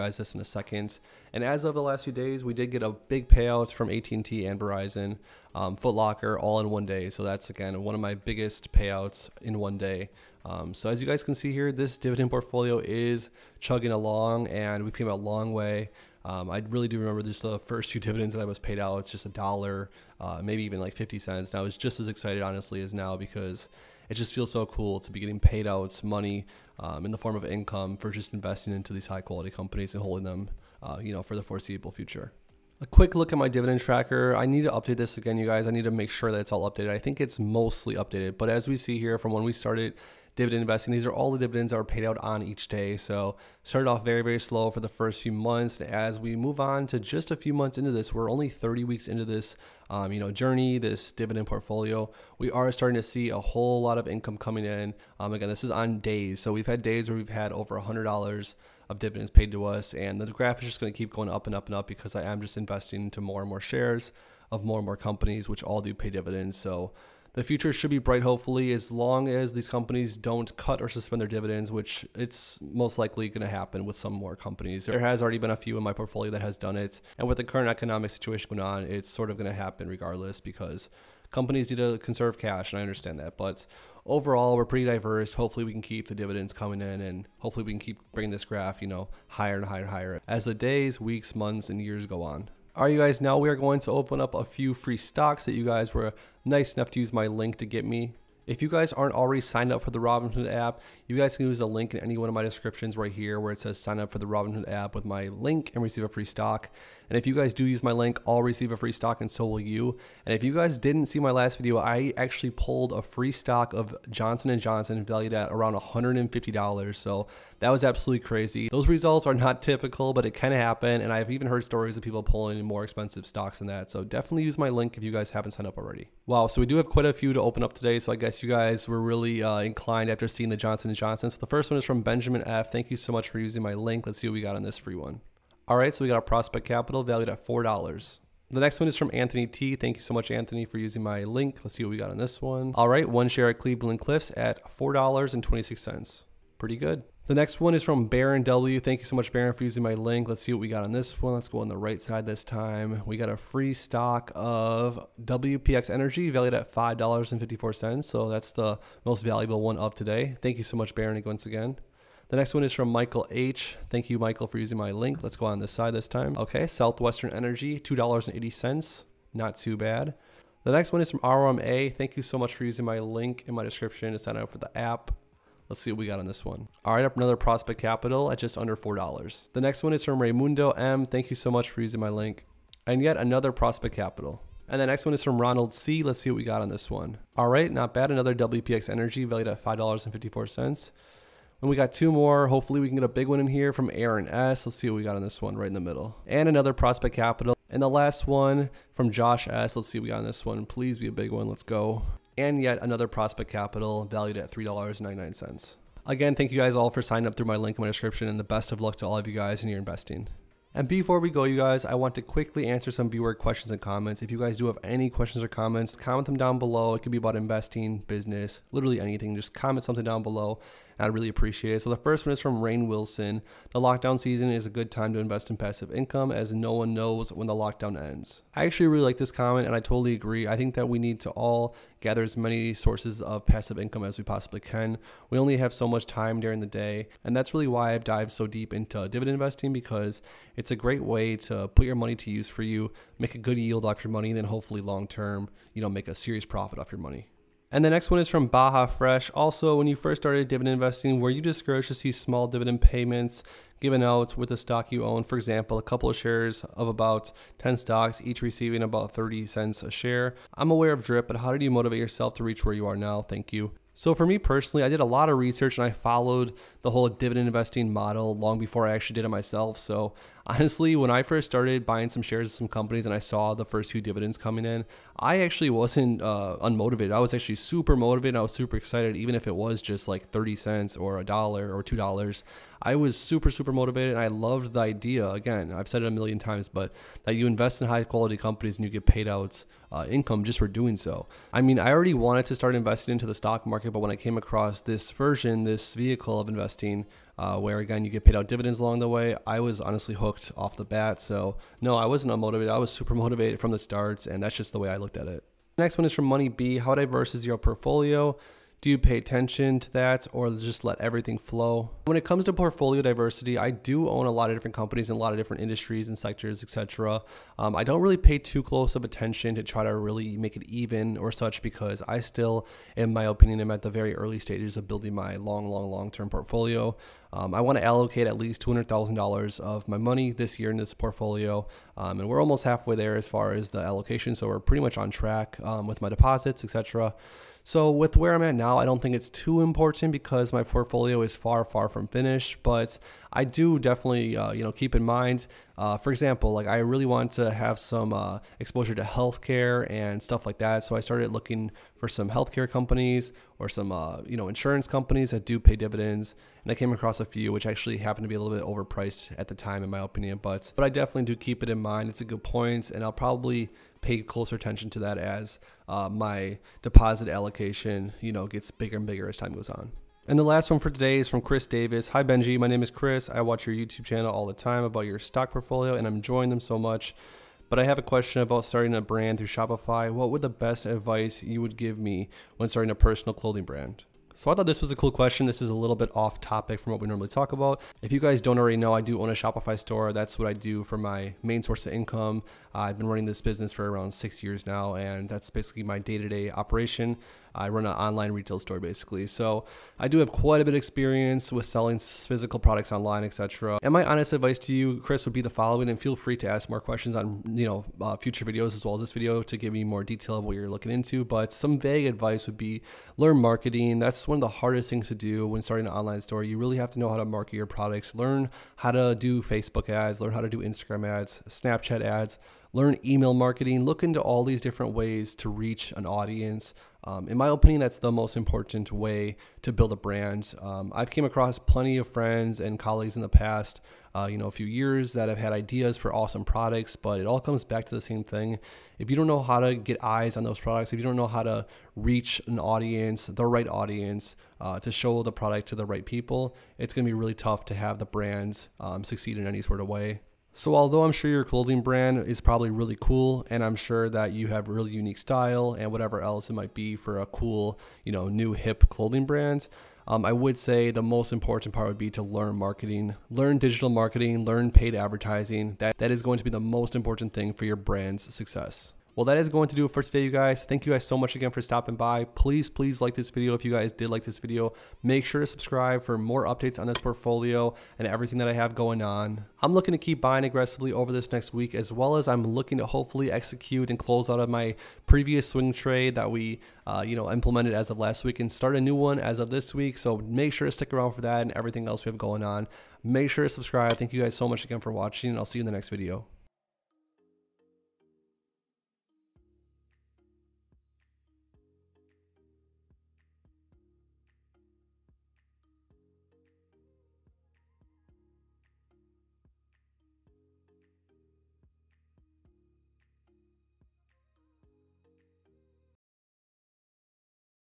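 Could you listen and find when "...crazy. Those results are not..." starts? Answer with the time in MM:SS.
01:58.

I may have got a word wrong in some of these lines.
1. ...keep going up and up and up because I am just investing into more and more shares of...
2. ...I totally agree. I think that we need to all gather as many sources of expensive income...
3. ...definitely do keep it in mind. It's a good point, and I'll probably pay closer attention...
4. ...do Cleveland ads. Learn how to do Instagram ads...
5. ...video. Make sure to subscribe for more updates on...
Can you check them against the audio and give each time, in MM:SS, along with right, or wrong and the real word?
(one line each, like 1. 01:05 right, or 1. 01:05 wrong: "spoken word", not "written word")
1. 01:00 right
2. 03:49 wrong: "passive", not "expensive"
3. 06:00 right
4. 06:59 wrong: "Facebook", not "Cleveland"
5. 07:54 right.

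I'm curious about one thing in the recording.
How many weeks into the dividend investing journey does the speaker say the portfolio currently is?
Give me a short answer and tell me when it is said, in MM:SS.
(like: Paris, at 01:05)
30, at 00:48.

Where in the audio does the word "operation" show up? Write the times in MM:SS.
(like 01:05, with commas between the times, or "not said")
06:36.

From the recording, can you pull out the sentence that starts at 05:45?
Uh, for example, like I really want to have some uh, exposure to healthcare and stuff like that.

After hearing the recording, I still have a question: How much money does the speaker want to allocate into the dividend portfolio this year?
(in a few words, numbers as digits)
$200,000.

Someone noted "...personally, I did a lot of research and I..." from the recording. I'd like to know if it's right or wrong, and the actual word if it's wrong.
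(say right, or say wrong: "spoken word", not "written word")
right.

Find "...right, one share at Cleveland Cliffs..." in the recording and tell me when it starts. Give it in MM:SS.
02:22.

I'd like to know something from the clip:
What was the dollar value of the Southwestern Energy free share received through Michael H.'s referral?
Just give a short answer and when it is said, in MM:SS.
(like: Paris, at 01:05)
$2.80, at 02:47.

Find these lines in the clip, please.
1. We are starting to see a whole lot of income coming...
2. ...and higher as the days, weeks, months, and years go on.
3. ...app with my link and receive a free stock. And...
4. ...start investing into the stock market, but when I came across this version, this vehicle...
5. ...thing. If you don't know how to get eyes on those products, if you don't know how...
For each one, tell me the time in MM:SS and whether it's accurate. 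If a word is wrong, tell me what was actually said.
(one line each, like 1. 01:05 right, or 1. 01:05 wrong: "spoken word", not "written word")
1. 00:52 right
2. 01:29 right
3. 01:44 right
4. 04:52 right
5. 07:18 right.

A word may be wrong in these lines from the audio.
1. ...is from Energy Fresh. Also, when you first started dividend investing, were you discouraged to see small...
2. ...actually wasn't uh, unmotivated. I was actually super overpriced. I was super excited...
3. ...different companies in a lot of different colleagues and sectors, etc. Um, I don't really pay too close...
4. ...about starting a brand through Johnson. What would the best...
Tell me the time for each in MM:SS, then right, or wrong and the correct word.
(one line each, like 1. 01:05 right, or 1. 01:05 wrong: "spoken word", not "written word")
1. 04:08 wrong: "Baja", not "Energy"
2. 04:35 wrong: "motivated", not "overpriced"
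3. 05:14 wrong: "industries", not "colleagues"
4. 06:18 wrong: "Shopify", not "Johnson".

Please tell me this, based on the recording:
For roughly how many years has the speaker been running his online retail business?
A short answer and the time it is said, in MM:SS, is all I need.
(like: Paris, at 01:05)
6, at 06:34.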